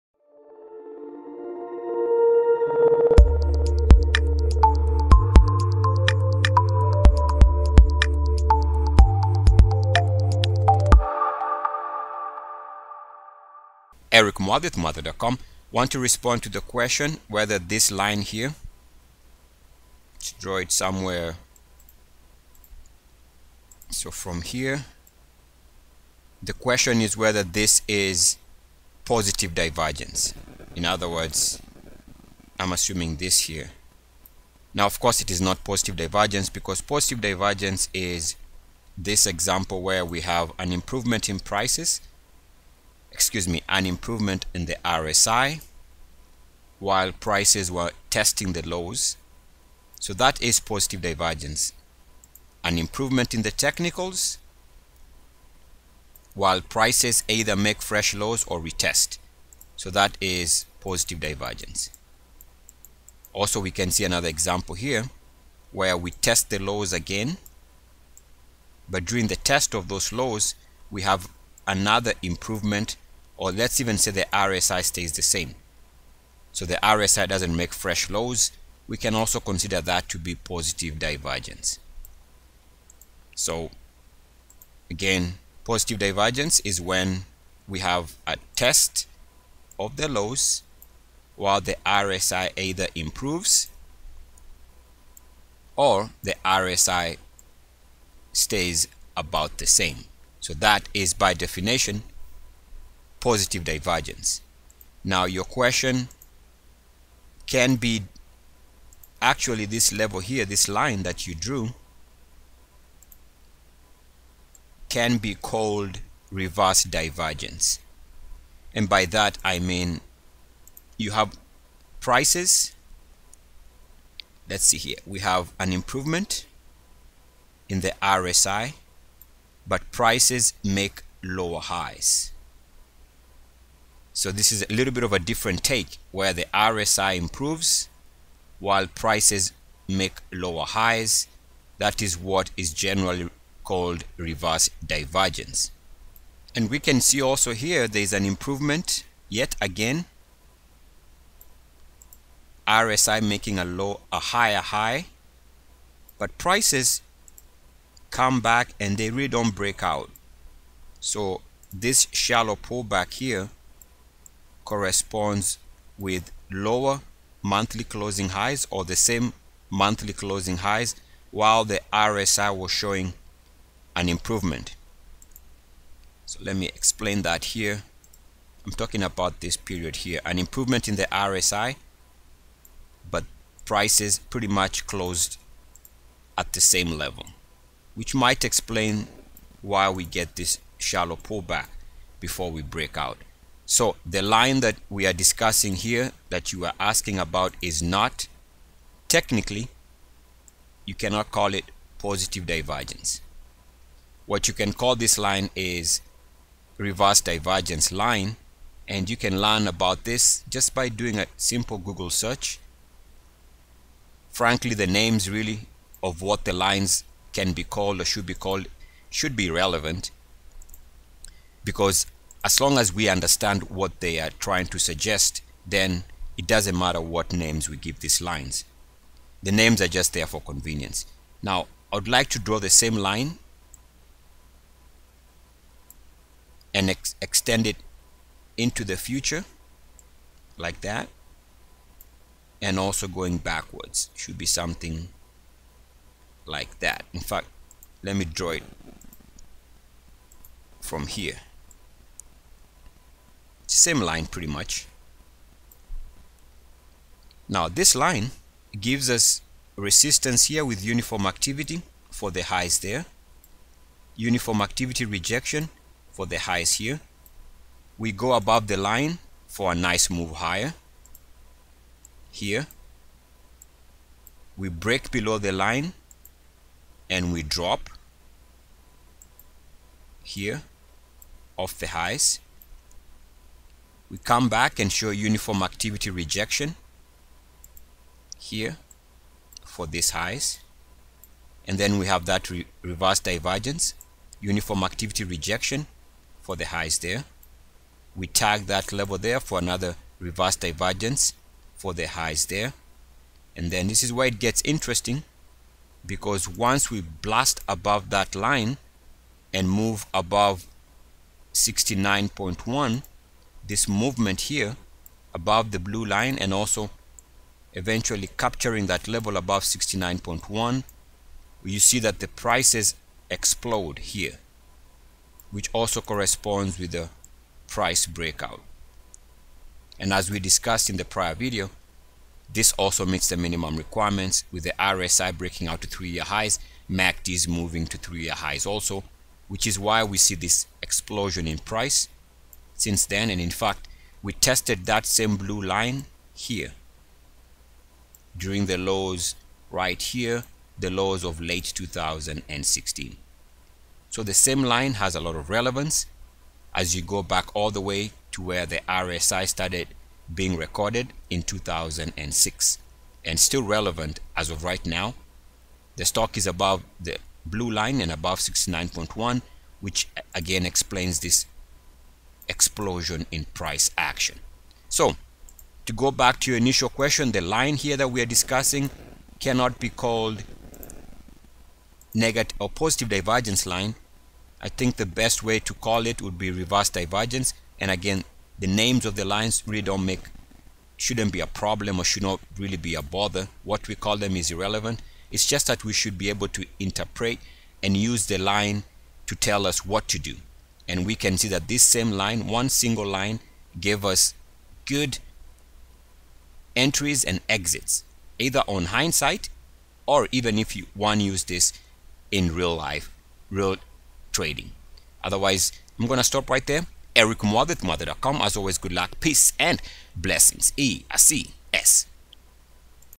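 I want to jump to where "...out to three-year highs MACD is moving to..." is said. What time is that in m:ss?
5:35.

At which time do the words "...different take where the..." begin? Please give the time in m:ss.
2:15.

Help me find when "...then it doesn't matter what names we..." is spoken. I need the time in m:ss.
3:45.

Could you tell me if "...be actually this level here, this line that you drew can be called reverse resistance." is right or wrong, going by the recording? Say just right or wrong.
wrong.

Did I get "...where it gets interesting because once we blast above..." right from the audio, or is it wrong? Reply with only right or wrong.
right.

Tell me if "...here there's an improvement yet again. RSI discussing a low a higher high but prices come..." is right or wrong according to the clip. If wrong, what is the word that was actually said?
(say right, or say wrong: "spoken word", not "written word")
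wrong: "making", not "discussing".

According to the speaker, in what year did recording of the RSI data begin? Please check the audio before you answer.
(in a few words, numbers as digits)
2006.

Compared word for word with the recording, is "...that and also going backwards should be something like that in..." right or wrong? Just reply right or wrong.
right.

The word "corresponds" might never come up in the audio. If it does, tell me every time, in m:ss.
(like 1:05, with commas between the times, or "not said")
2:44, 5:26.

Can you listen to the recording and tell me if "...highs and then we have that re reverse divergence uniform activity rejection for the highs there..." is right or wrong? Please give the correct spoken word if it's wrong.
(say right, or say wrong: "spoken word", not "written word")
right.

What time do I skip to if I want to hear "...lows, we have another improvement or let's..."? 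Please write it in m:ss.
1:10.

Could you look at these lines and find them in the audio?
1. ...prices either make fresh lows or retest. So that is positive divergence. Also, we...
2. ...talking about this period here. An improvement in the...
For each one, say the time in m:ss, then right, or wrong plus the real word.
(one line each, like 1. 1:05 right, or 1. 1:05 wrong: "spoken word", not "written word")
1. 0:56 right
2. 2:58 right.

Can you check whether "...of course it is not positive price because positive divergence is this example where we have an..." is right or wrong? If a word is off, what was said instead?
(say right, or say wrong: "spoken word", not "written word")
wrong: "divergence", not "price".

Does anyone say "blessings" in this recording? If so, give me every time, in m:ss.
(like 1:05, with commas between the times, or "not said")
7:00.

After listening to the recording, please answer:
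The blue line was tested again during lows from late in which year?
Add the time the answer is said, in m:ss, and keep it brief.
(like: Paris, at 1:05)
2016, at 5:51.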